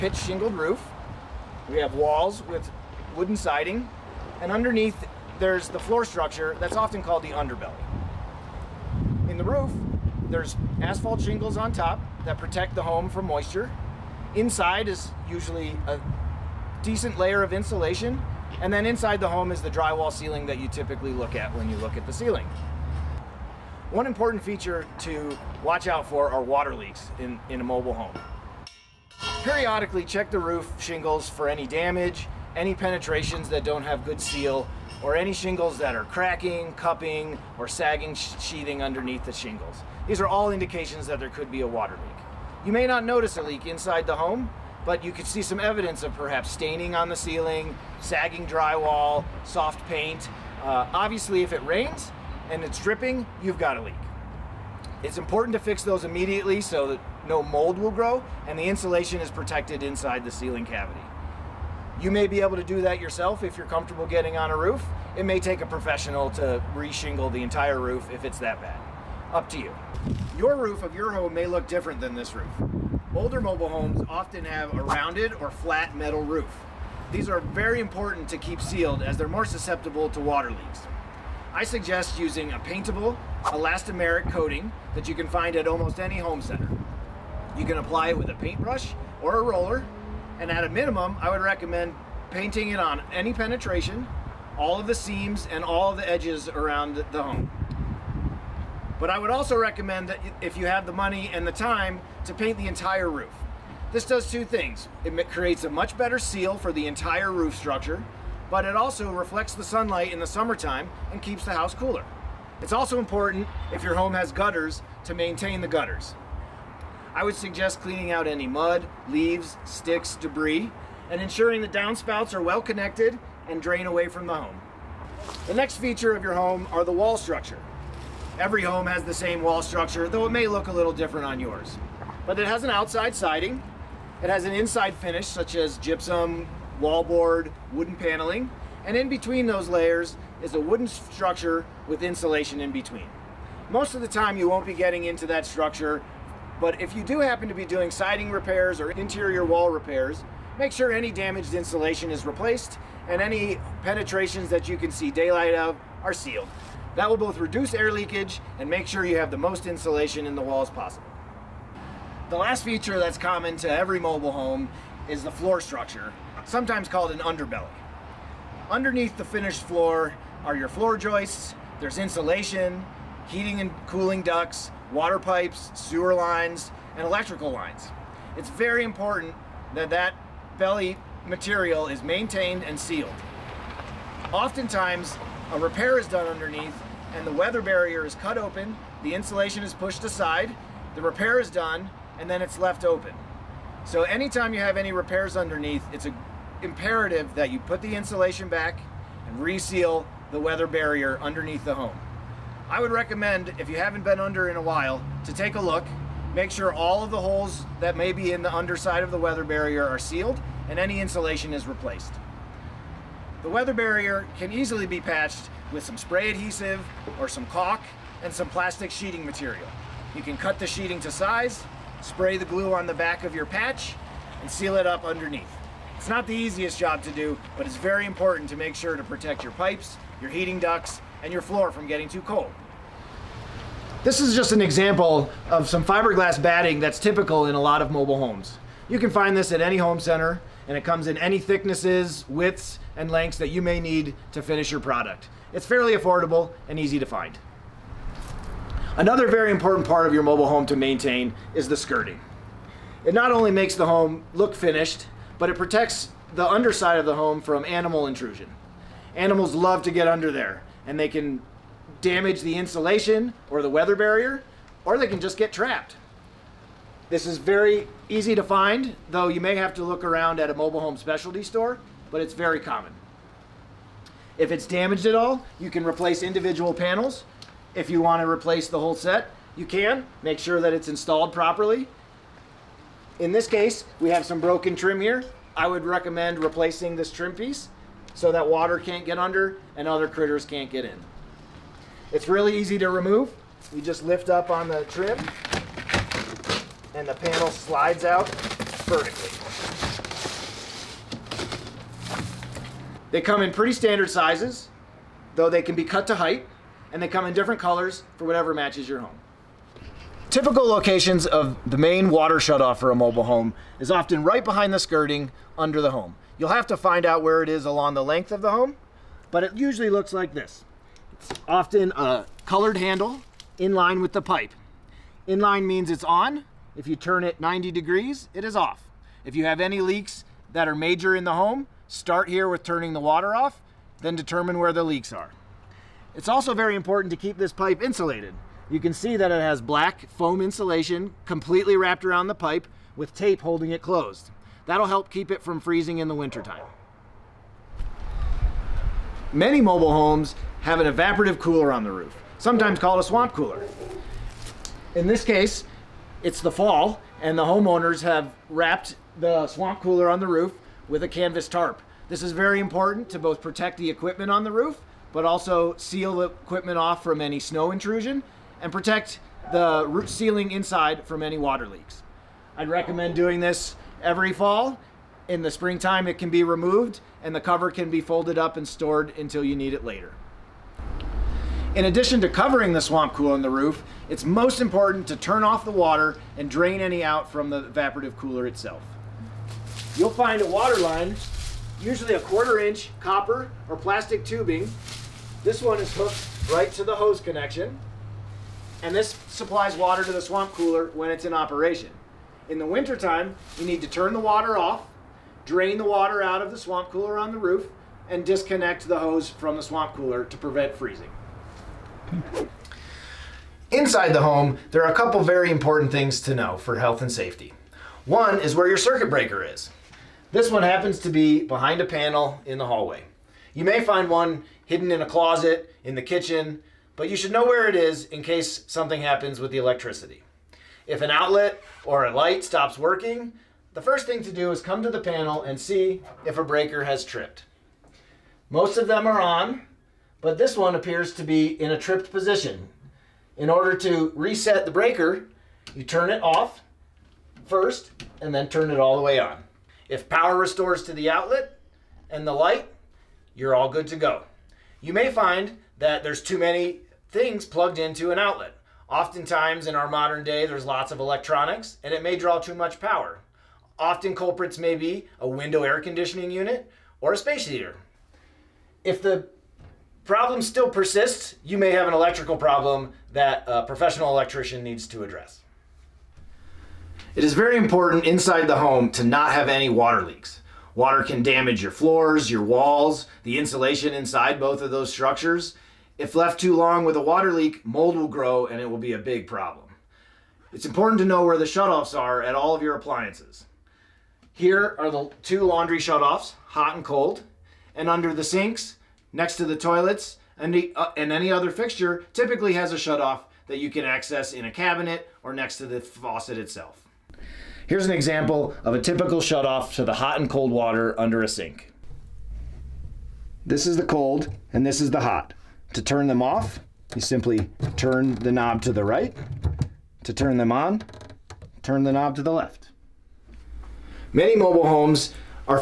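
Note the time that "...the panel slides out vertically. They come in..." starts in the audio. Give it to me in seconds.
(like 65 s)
297 s.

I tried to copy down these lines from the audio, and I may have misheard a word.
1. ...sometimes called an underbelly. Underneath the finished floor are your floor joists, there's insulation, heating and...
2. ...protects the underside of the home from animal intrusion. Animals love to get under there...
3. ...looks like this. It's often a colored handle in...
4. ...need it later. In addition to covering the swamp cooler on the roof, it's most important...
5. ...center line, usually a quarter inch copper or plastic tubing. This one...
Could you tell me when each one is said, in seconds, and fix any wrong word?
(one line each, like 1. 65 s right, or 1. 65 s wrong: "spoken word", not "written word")
1. 166 s right
2. 255 s right
3. 319 s right
4. 379 s right
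5. 390 s wrong: "water", not "center".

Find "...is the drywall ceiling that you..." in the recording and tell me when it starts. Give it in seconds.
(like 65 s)
19 s.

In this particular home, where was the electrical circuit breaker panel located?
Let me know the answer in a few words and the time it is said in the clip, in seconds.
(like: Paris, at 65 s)
in the hallway, at 422 s.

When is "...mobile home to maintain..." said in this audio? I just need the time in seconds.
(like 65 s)
250 s.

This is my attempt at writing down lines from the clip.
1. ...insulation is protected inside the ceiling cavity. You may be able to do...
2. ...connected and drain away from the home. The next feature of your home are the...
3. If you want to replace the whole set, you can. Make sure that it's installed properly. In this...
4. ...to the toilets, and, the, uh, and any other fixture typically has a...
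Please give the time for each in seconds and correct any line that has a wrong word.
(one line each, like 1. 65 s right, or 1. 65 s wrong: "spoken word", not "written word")
1. 58 s right
2. 122 s right
3. 277 s right
4. 499 s right.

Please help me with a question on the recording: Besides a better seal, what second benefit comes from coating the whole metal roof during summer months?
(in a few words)
keeps the house cooler.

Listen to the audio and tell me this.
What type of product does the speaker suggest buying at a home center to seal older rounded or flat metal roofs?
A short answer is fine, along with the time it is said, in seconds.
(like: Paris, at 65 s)
paintable elastomeric coating, at 82 s.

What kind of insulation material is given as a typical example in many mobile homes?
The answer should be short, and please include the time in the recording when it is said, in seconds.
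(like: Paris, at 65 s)
fiberglass batting, at 235 s.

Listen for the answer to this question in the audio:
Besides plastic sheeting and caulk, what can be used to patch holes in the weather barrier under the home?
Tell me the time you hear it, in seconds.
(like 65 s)
215 s.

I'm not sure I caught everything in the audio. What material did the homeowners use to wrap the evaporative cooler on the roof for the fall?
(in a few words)
canvas tarp.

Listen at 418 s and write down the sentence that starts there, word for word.
One is where your circuit breaker is.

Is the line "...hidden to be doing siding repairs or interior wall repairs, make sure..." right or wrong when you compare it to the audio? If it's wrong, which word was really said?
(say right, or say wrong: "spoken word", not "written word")
wrong: "happen", not "hidden".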